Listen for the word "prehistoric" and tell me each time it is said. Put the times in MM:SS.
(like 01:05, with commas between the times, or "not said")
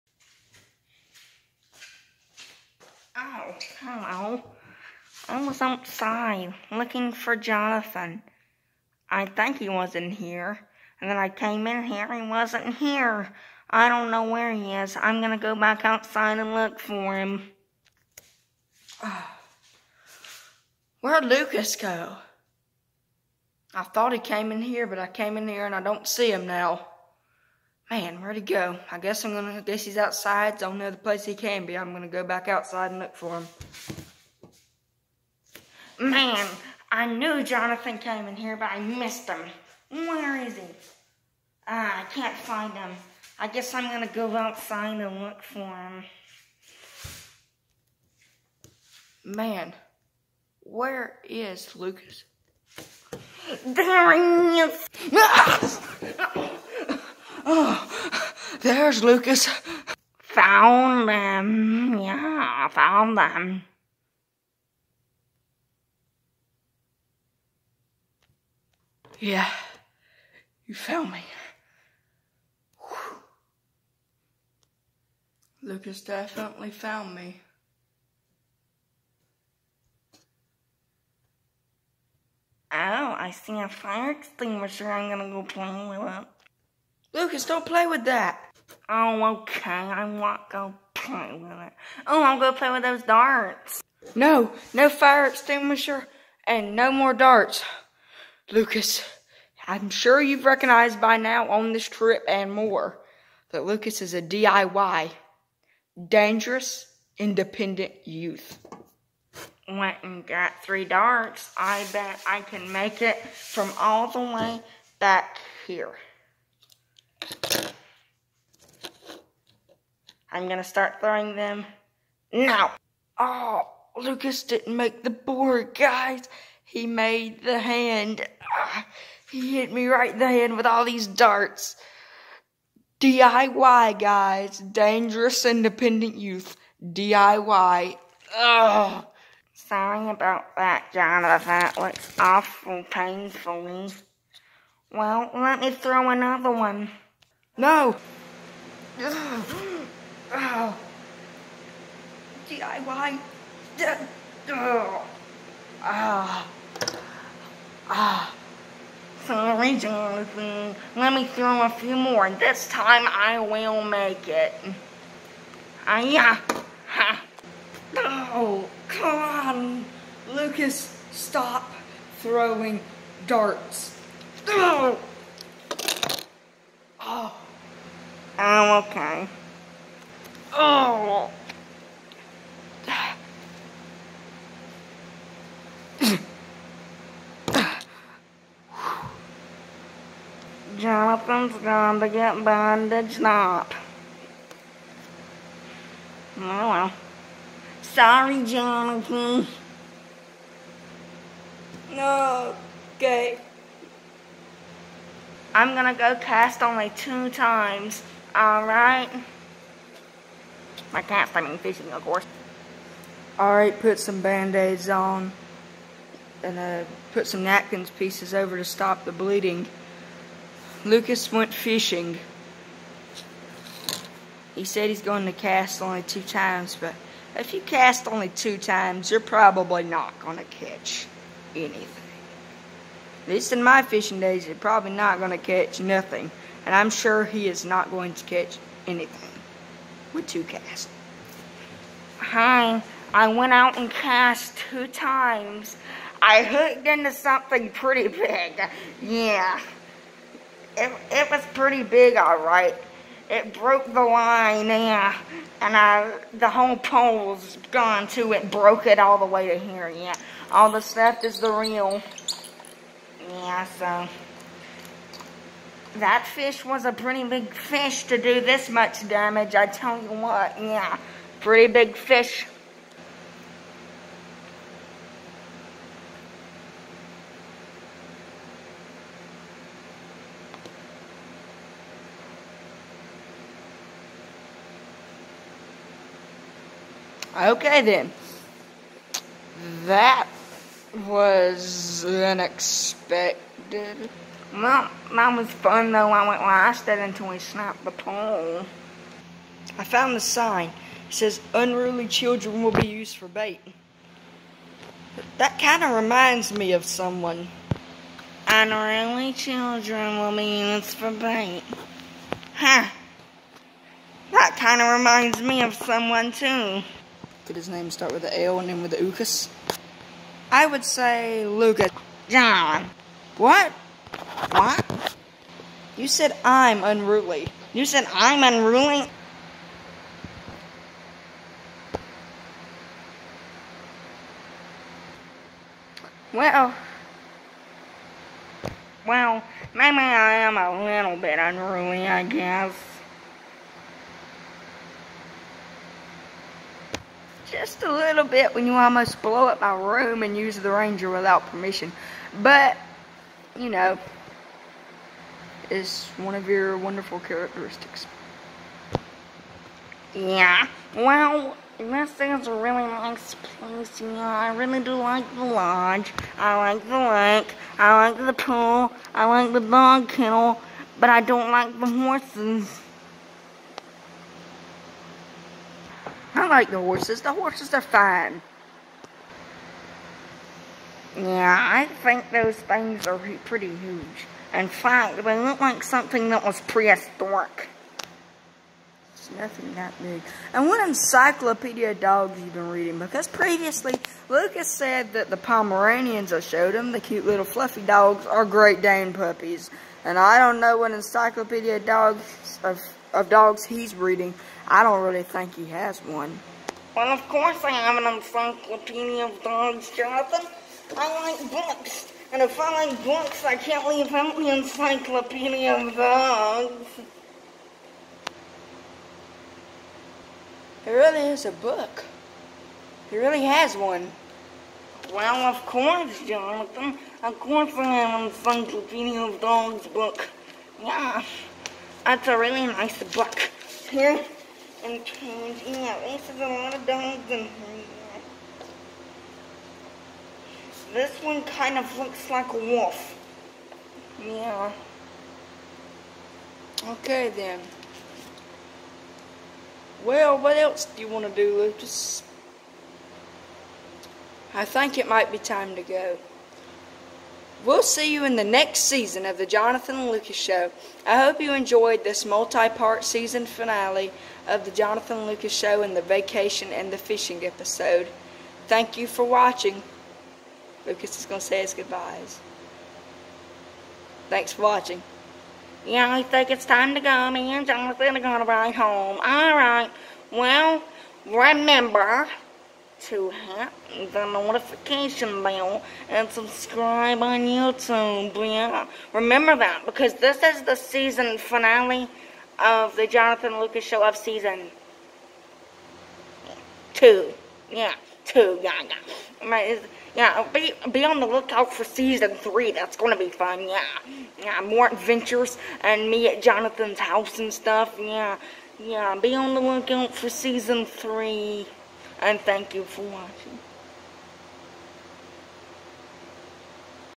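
06:26.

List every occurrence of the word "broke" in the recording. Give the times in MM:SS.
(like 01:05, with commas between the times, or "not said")
04:13, 04:18.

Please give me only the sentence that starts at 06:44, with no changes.
I don't really think he has one.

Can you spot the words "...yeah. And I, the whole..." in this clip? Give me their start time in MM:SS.
04:14.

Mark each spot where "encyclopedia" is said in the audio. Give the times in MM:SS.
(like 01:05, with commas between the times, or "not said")
06:30, 06:40, 06:48, 06:54, 07:08.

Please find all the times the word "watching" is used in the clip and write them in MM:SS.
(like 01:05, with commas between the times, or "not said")
07:49, 07:54, 08:33.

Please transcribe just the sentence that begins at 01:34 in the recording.
No, no fire extinguisher and no more darts.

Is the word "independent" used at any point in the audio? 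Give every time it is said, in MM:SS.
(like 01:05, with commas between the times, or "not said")
01:47, 02:15.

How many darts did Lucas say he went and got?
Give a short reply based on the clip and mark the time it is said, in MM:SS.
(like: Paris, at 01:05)
3, at 01:50.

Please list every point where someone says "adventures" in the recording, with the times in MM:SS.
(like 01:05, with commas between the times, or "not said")
08:24.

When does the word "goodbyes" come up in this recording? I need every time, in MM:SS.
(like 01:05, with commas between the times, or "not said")
07:51.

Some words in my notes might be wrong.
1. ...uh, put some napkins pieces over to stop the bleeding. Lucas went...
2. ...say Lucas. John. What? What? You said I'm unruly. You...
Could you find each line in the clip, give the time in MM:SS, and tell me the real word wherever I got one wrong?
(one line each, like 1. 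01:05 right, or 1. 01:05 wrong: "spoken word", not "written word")
1. 03:36 right
2. 05:20 right.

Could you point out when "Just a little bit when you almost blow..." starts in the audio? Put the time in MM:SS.
05:47.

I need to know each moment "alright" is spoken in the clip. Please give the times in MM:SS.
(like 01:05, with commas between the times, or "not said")
03:28, 03:33, 04:12.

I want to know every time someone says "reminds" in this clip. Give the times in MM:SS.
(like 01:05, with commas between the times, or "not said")
05:06, 05:14.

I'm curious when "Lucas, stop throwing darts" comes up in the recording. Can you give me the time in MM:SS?
02:50.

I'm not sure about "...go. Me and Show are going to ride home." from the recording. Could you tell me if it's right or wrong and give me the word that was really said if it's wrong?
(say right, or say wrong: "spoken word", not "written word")
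wrong: "Jonathan", not "Show".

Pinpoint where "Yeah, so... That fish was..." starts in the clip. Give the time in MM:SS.
04:23.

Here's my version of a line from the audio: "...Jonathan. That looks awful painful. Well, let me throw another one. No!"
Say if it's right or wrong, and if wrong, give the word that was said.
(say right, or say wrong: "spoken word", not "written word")
right.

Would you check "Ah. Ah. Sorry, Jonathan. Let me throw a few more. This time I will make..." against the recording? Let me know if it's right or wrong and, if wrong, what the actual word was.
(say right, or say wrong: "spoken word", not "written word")
right.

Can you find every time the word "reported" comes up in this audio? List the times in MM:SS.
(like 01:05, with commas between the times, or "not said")
not said.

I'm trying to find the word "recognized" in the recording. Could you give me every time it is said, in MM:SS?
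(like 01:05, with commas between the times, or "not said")
01:40.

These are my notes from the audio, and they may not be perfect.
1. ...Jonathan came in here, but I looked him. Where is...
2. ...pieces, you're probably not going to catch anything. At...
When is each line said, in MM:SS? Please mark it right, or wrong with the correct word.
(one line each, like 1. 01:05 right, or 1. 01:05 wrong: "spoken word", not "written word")
1. 00:37 wrong: "missed", not "looked"
2. 03:48 wrong: "times", not "pieces".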